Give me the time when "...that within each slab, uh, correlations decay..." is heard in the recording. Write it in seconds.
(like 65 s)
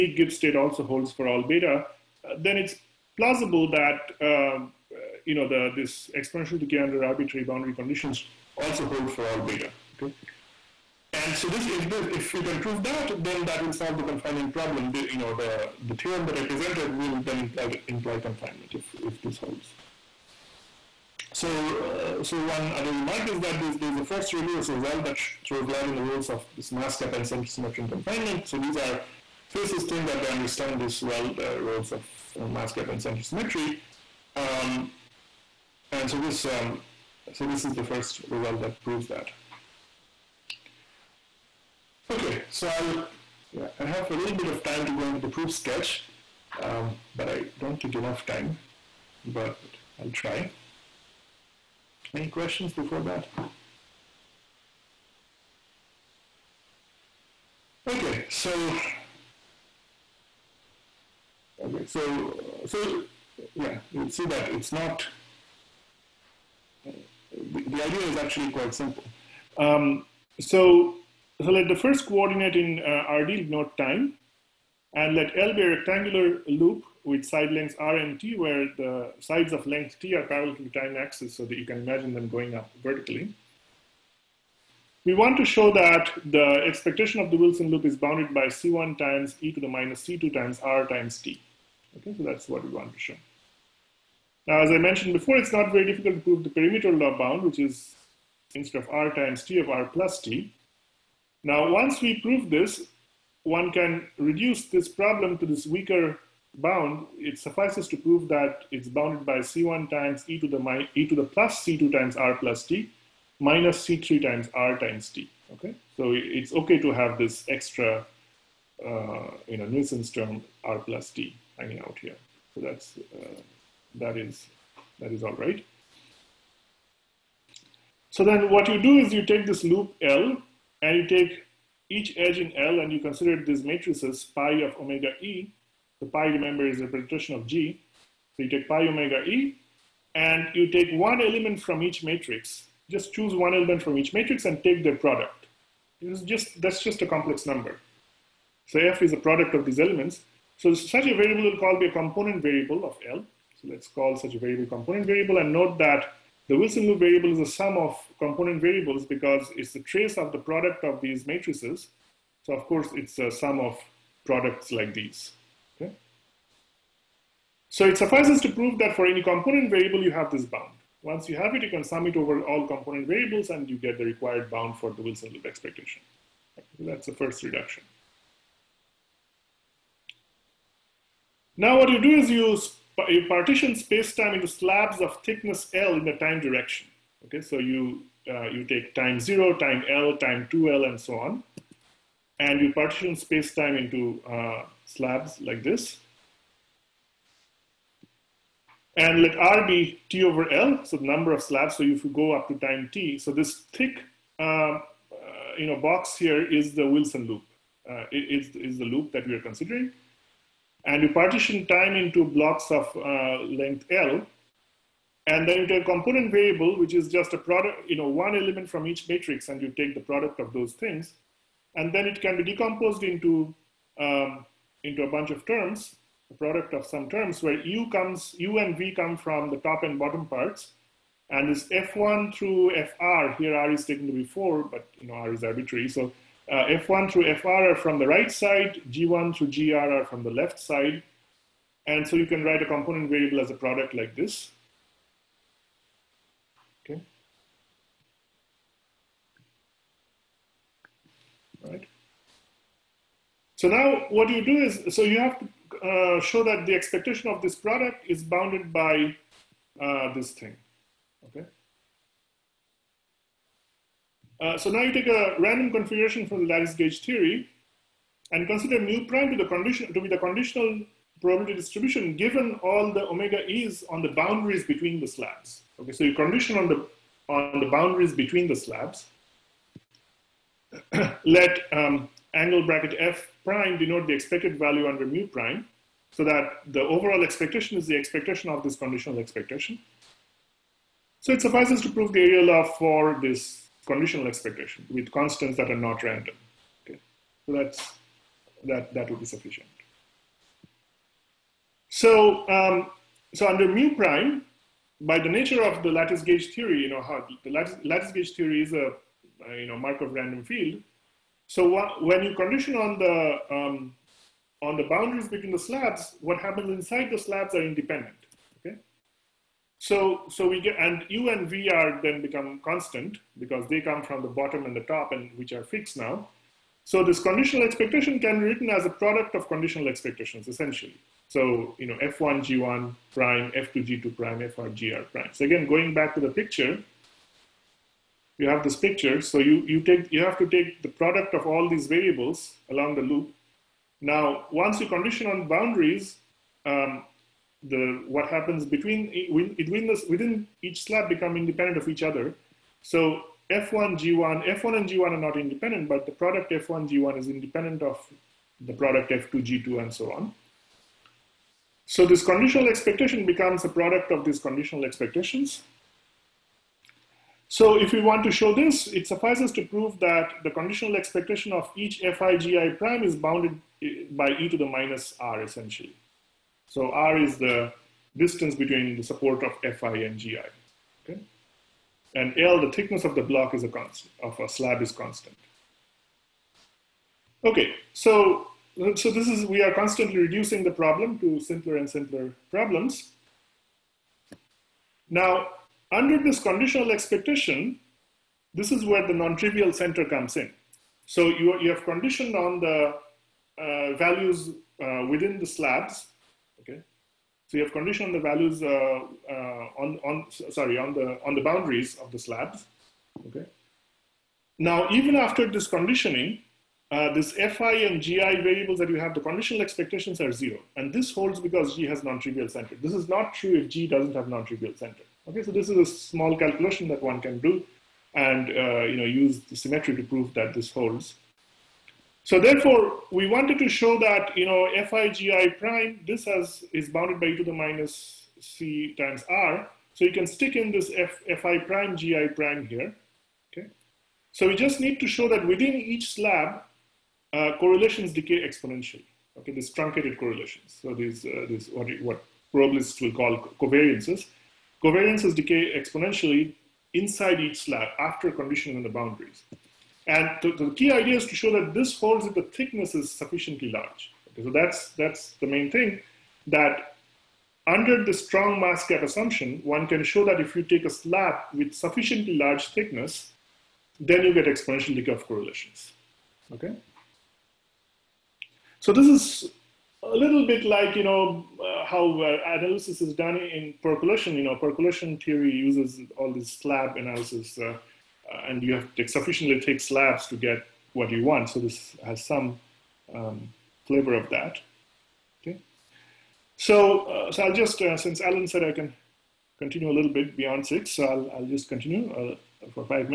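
445 s.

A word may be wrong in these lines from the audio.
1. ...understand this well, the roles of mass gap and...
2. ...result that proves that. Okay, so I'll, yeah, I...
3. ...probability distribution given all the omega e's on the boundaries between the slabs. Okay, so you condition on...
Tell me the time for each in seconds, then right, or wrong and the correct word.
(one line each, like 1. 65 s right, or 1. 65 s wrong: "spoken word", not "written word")
1. 30 s right
2. 38 s right
3. 271 s right.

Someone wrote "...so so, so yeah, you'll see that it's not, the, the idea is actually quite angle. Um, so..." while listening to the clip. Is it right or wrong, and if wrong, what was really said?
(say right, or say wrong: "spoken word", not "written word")
wrong: "simple", not "angle".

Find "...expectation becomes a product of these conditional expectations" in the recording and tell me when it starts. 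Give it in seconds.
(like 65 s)
362 s.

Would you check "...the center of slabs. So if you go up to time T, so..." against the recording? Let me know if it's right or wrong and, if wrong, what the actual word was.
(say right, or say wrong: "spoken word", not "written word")
wrong: "number", not "center".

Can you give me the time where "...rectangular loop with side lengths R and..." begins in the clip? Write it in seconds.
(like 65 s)
75 s.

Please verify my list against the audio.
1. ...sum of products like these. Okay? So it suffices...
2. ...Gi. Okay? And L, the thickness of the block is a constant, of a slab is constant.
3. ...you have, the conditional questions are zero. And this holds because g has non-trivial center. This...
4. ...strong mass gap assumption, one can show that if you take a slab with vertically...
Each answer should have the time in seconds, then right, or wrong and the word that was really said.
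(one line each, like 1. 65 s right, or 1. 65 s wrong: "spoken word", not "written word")
1. 163 s right
2. 380 s right
3. 418 s wrong: "expectations", not "questions"
4. 468 s wrong: "sufficiently", not "vertically".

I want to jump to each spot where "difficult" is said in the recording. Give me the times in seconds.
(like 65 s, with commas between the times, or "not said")
95 s.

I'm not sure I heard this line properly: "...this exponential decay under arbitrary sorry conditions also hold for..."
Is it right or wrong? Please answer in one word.
wrong.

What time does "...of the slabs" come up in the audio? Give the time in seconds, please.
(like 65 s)
411 s.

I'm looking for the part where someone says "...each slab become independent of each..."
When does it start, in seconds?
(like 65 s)
350 s.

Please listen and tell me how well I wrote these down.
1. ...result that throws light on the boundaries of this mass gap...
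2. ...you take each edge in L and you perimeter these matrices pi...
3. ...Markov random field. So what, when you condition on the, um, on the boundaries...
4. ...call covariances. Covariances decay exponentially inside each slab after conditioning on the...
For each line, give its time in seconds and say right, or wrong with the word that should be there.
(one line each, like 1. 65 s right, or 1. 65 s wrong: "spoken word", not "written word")
1. 24 s wrong: "roles", not "boundaries"
2. 130 s wrong: "consider", not "perimeter"
3. 309 s right
4. 453 s right.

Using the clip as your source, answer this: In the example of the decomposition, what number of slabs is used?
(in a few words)
4.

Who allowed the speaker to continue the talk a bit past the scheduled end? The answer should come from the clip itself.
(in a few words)
Alan.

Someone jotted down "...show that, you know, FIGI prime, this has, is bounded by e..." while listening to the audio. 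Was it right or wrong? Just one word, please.
right.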